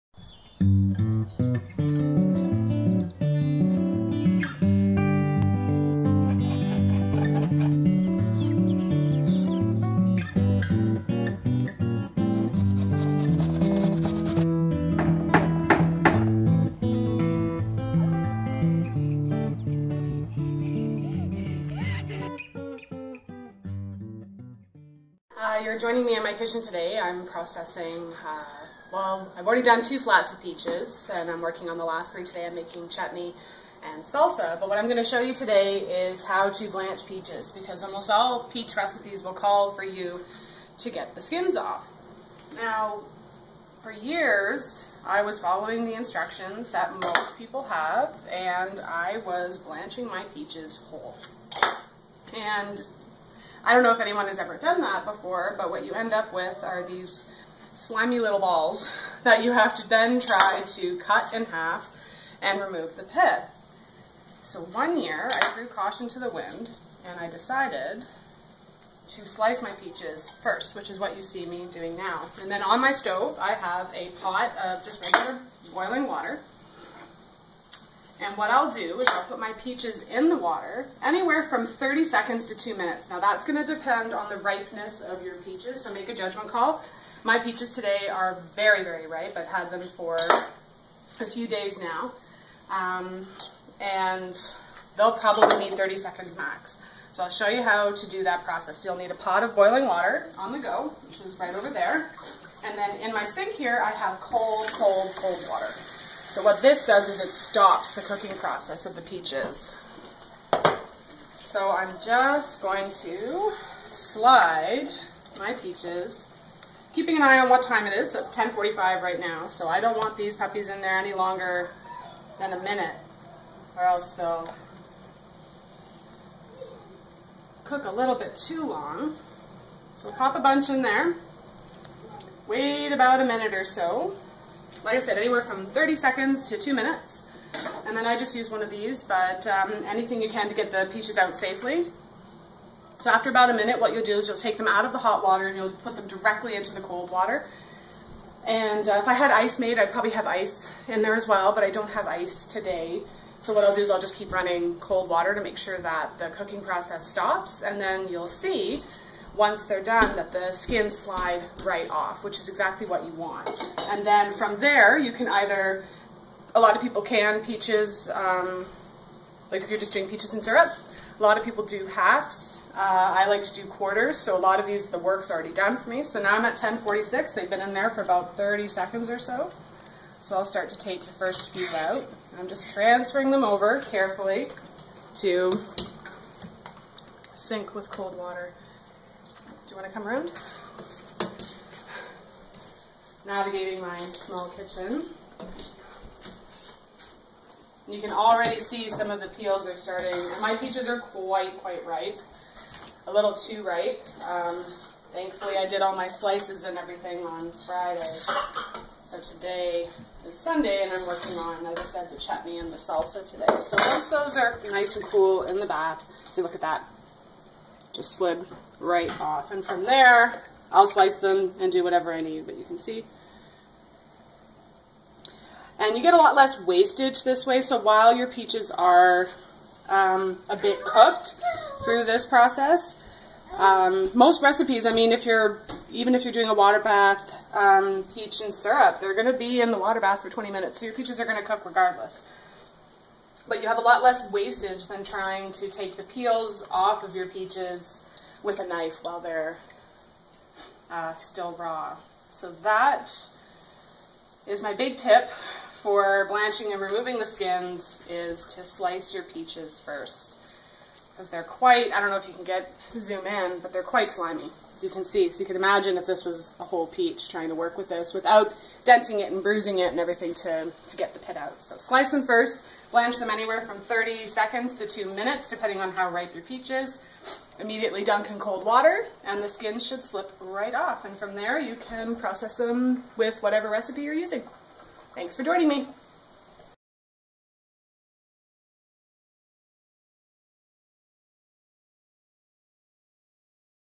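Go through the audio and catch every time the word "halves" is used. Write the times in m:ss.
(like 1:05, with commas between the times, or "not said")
2:51.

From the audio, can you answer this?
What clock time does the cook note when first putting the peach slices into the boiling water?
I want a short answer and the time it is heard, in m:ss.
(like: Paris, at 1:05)
10:45, at 1:58.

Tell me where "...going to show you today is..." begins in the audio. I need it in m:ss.
0:34.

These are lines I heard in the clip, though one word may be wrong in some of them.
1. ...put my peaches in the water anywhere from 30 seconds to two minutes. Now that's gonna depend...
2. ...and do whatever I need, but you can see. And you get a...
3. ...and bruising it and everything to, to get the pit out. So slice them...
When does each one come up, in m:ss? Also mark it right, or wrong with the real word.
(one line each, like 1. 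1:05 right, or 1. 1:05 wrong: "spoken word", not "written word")
1. 1:19 right
2. 3:41 right
3. 4:29 right.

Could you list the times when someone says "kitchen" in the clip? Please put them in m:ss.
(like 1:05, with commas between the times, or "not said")
0:26, 3:14.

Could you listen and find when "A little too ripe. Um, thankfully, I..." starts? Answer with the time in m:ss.
3:23.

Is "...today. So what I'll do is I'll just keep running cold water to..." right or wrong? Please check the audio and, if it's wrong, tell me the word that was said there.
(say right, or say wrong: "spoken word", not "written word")
right.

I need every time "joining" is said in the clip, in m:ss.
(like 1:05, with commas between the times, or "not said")
0:25, 4:45.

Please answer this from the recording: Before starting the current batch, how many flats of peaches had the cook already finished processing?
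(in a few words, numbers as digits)
2.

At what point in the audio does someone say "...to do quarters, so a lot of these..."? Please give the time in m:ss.
2:53.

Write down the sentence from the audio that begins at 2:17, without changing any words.
And then I just use one of these, but um, anything you can to get the peaches out safely.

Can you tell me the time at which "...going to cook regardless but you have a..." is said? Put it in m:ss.
4:01.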